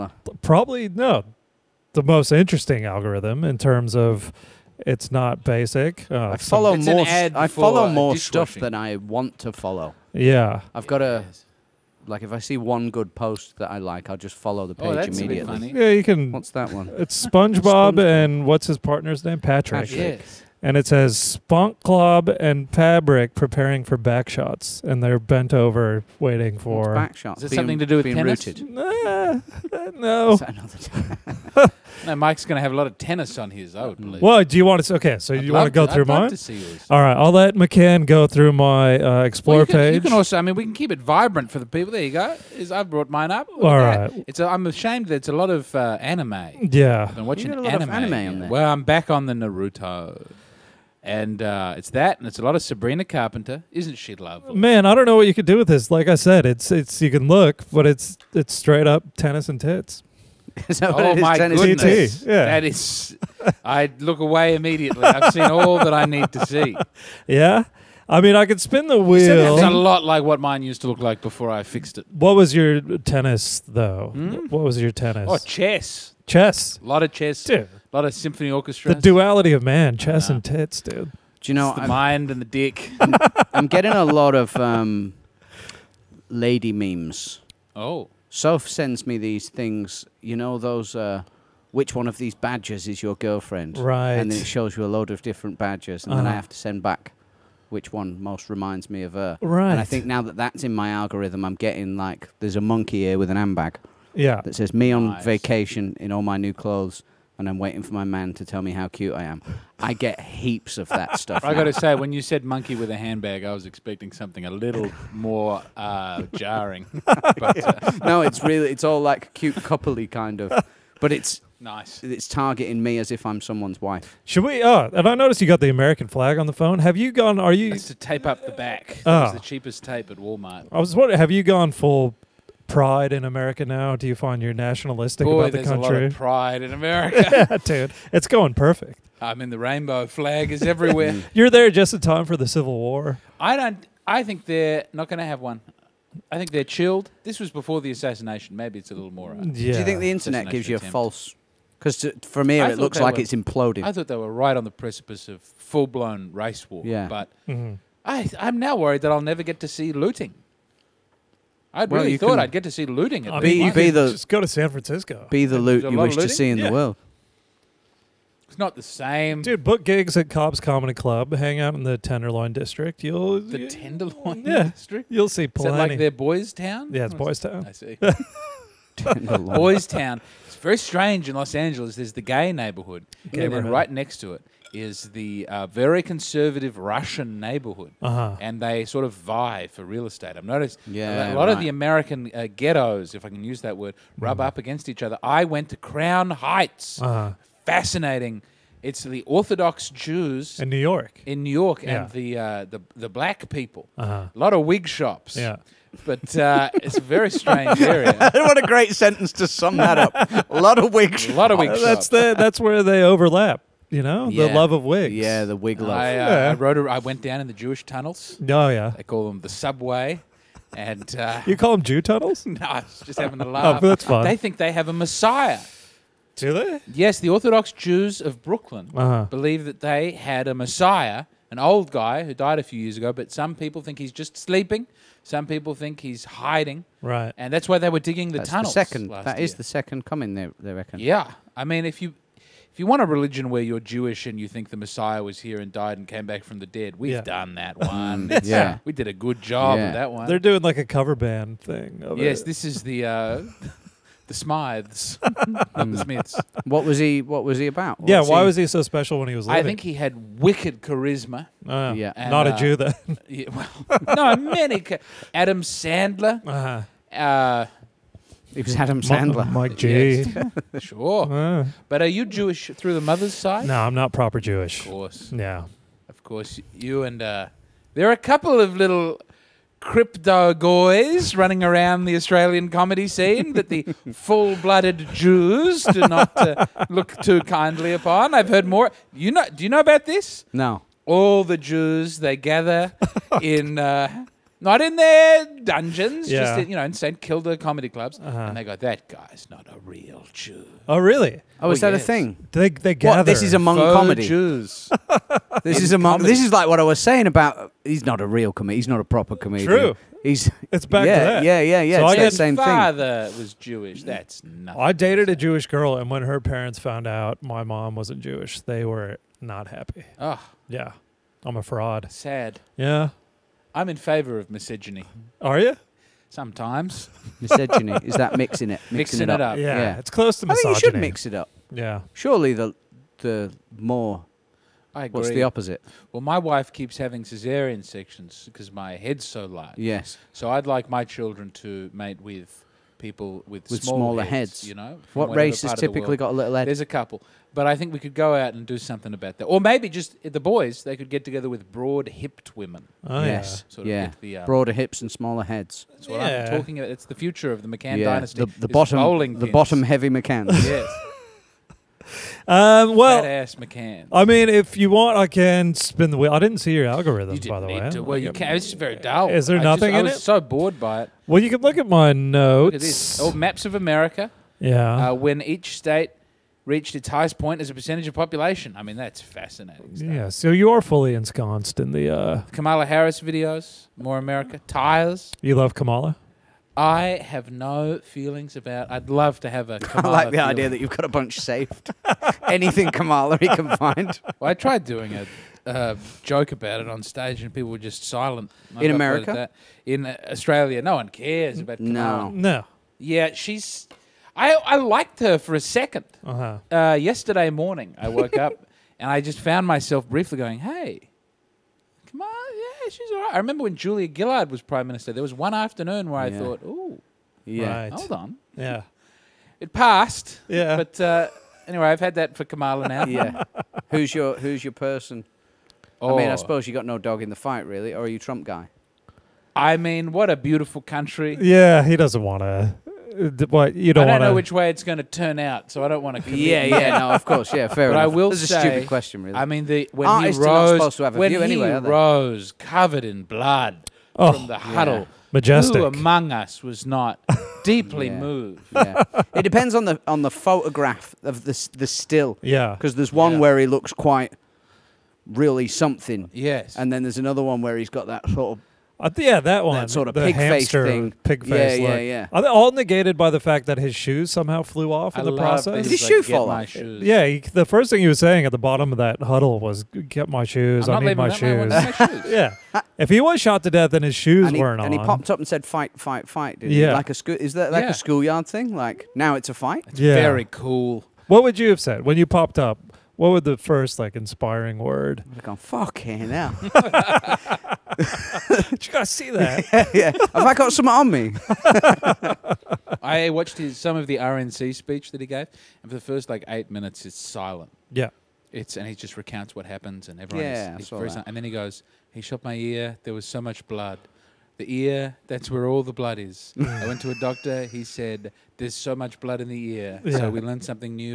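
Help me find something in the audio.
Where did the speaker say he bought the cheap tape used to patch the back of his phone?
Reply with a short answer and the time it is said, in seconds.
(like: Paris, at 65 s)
Walmart, at 130 s.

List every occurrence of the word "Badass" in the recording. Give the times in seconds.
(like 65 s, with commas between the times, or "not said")
363 s.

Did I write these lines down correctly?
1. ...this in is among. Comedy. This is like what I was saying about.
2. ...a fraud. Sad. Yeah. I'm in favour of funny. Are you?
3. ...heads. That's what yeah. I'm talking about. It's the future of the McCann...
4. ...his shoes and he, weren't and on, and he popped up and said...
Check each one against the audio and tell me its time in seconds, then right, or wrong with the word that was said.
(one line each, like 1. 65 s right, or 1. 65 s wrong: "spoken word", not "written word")
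1. 305 s right
2. 321 s wrong: "misogyny", not "funny"
3. 355 s right
4. 474 s right.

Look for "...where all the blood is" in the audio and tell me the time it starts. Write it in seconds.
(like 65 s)
505 s.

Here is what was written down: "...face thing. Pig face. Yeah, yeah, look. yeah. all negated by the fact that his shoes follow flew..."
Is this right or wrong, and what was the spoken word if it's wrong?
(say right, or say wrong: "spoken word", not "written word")
wrong: "somehow", not "follow".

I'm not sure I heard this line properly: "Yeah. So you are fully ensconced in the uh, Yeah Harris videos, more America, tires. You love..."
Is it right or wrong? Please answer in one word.
wrong.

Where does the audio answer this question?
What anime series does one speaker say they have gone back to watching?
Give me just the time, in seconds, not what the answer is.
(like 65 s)
49 s.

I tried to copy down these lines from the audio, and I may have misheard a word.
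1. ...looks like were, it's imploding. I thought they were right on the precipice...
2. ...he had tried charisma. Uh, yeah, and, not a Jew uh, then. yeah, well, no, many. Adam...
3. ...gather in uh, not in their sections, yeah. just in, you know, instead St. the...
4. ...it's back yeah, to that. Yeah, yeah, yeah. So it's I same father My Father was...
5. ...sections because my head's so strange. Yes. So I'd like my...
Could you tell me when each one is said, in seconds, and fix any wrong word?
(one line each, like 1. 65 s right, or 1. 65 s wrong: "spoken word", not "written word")
1. 152 s right
2. 259 s wrong: "wicked", not "tried"
3. 292 s wrong: "dungeons", not "sections"
4. 310 s right
5. 337 s wrong: "large", not "strange".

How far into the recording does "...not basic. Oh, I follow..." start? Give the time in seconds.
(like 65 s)
5 s.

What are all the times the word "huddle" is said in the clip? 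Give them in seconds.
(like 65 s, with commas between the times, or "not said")
444 s, 469 s.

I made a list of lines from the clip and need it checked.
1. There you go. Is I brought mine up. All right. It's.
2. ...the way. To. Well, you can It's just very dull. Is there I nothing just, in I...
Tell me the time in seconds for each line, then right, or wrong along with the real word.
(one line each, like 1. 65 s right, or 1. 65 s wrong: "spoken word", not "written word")
1. 41 s right
2. 367 s right.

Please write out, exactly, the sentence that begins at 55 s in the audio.
Like I said, it's it's you can look, but it's it's straight up tennis and tits.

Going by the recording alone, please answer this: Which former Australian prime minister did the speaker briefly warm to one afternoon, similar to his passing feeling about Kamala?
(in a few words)
Julia Gillard.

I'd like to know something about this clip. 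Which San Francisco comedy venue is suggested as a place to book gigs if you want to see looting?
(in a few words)
Cobb's Comedy Club.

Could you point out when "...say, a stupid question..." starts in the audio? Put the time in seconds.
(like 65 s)
438 s.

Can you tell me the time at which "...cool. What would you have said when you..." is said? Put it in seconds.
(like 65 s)
480 s.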